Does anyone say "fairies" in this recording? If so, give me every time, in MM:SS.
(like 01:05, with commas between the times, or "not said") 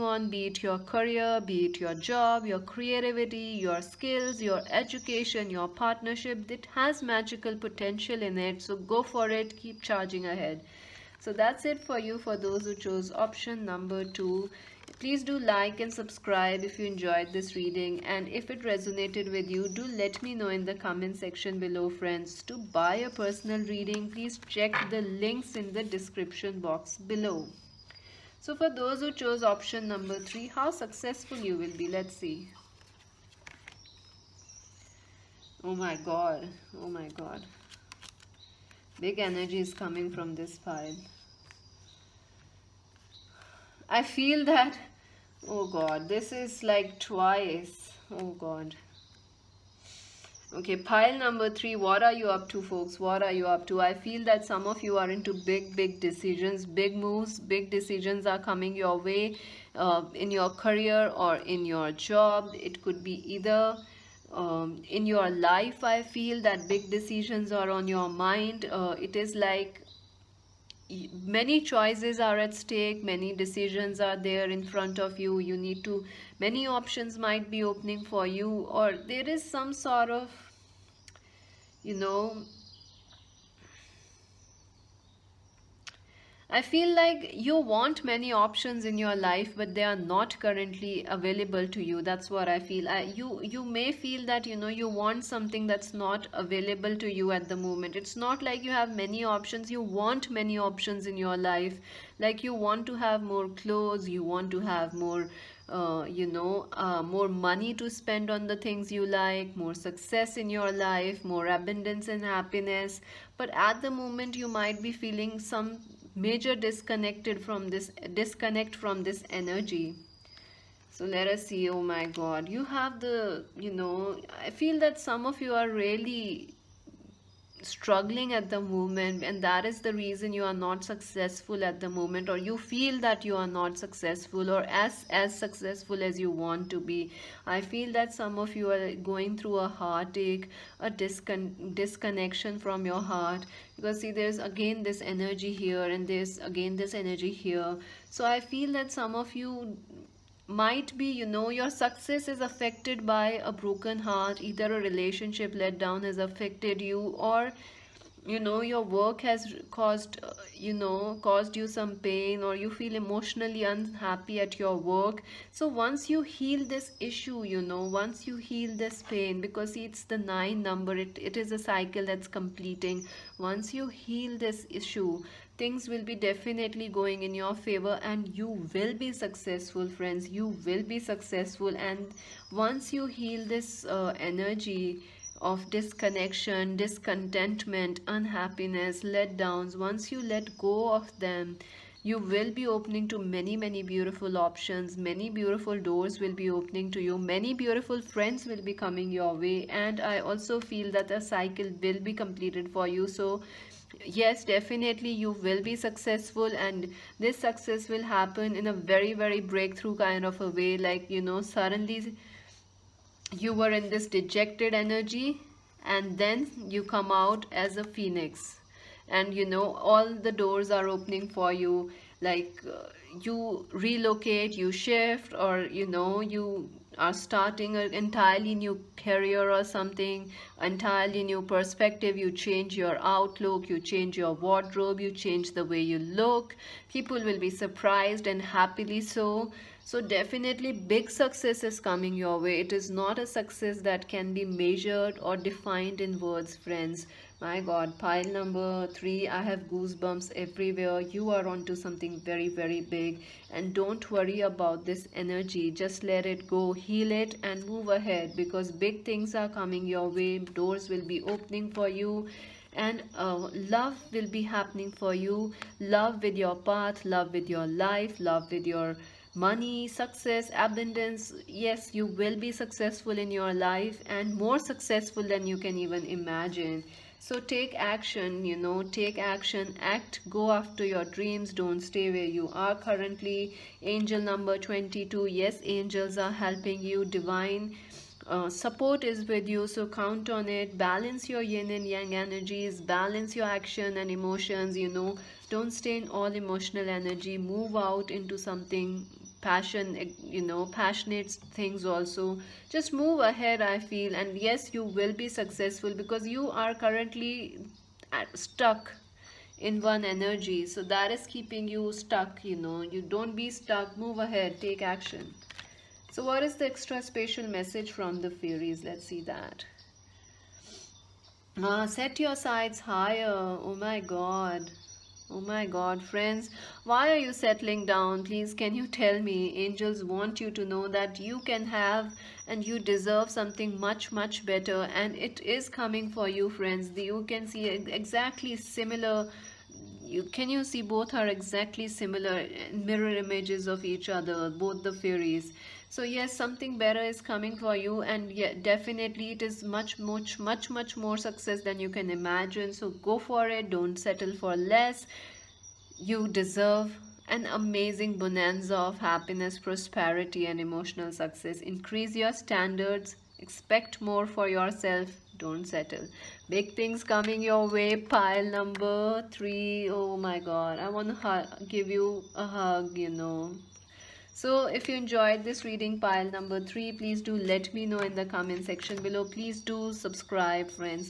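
05:18, 05:44.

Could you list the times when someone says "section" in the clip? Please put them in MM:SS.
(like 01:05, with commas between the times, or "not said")
00:21, 06:18.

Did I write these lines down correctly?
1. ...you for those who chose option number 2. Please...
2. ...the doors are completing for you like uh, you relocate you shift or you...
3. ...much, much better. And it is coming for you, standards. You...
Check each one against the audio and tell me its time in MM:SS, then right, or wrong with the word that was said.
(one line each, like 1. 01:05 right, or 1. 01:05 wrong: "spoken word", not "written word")
1. 00:11 right
2. 03:40 wrong: "opening", not "completing"
3. 05:33 wrong: "friends", not "standards".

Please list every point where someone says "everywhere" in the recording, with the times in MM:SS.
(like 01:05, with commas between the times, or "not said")
04:10.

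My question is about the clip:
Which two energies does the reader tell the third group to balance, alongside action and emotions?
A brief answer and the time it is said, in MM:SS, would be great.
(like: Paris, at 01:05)
yin and yang, at 04:51.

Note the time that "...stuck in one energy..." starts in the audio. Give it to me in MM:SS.
05:08.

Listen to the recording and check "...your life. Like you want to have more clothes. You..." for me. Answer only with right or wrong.
right.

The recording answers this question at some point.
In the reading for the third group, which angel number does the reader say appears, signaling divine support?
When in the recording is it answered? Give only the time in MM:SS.
04:43.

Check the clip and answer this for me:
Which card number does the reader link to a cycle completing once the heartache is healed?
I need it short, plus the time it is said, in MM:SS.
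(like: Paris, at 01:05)
9, at 02:50.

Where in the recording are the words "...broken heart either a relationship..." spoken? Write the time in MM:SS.
02:33.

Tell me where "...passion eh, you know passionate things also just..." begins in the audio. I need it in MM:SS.
04:59.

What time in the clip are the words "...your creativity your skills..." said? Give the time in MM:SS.
00:02.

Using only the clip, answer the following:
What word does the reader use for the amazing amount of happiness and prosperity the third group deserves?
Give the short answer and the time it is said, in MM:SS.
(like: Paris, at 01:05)
bonanza, at 05:58.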